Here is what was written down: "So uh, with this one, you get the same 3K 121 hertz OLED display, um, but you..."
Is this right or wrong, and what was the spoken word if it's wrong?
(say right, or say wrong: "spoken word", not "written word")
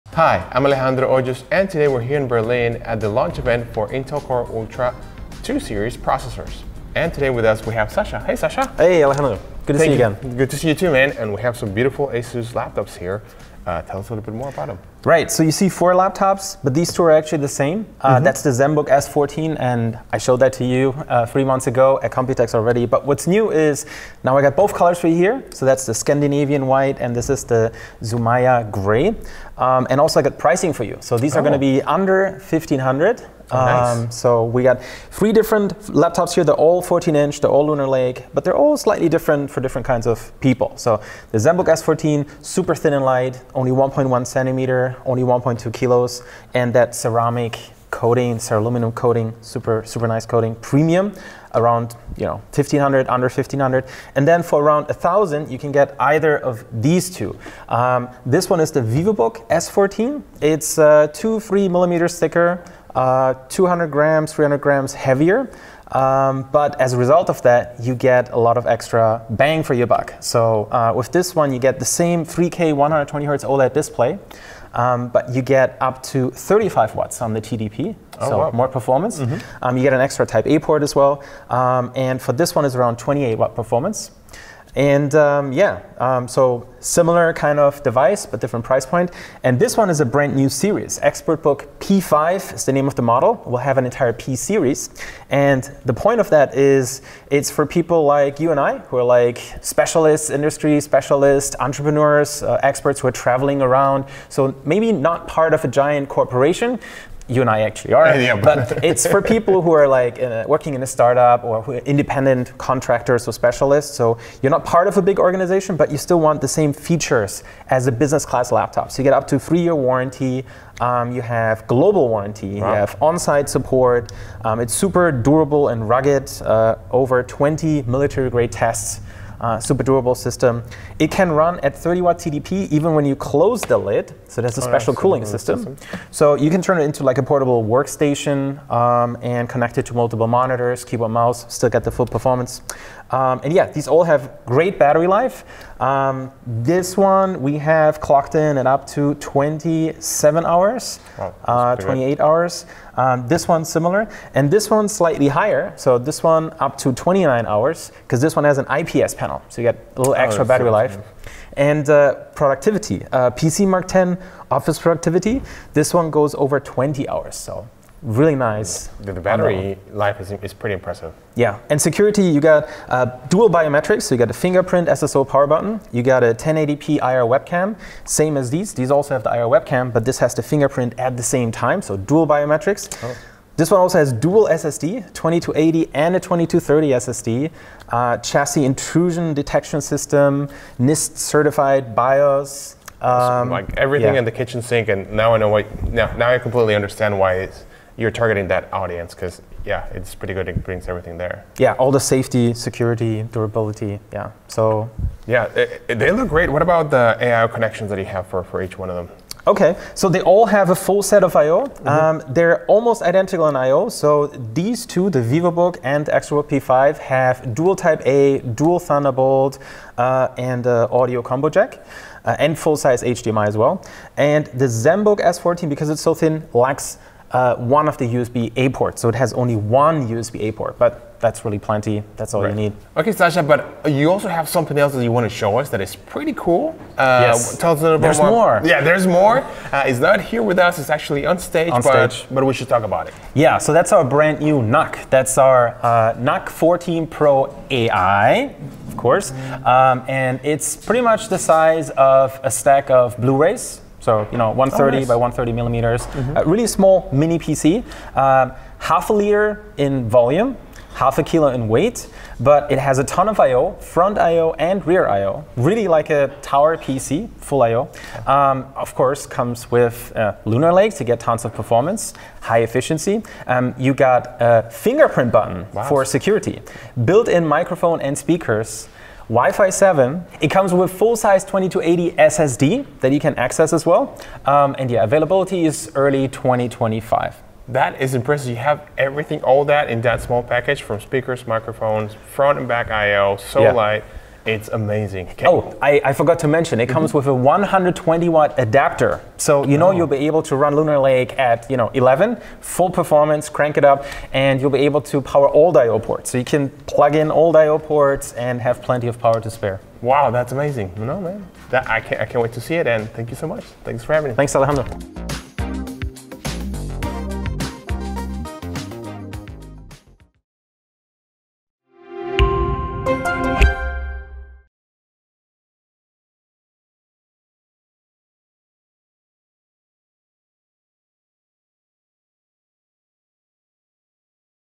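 wrong: "120", not "121".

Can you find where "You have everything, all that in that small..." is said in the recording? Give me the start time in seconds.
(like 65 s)
288 s.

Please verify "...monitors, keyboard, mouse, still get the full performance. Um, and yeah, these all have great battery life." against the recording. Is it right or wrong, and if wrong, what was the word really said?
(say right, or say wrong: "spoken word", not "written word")
right.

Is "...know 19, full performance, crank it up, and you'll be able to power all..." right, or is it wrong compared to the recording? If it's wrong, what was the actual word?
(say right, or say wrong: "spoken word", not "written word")
wrong: "11", not "19".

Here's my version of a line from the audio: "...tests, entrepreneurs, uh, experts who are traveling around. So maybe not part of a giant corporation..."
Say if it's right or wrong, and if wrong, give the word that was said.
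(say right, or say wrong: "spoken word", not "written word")
wrong: "specialists", not "tests".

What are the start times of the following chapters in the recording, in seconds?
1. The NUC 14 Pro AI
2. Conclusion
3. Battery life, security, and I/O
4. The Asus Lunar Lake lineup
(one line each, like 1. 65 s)
1. 232 s
2. 309 s
3. 143 s
4. 30 s.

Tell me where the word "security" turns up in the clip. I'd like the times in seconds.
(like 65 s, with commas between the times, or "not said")
171 s, 202 s, 276 s.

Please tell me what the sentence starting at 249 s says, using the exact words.
Um, and it's pretty much the size of a stack of Blu-rays so you know, 130 oh, nice.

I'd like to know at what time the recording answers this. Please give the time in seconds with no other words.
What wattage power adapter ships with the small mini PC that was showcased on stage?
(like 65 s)
297 s.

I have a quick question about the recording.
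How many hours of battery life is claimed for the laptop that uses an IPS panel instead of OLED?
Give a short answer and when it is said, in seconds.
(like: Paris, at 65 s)
29 hours, at 156 s.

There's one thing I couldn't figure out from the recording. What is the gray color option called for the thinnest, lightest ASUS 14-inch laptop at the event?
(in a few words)
Zumaia gray.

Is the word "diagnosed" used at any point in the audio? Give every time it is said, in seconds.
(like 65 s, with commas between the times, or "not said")
not said.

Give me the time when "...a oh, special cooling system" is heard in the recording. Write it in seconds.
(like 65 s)
134 s.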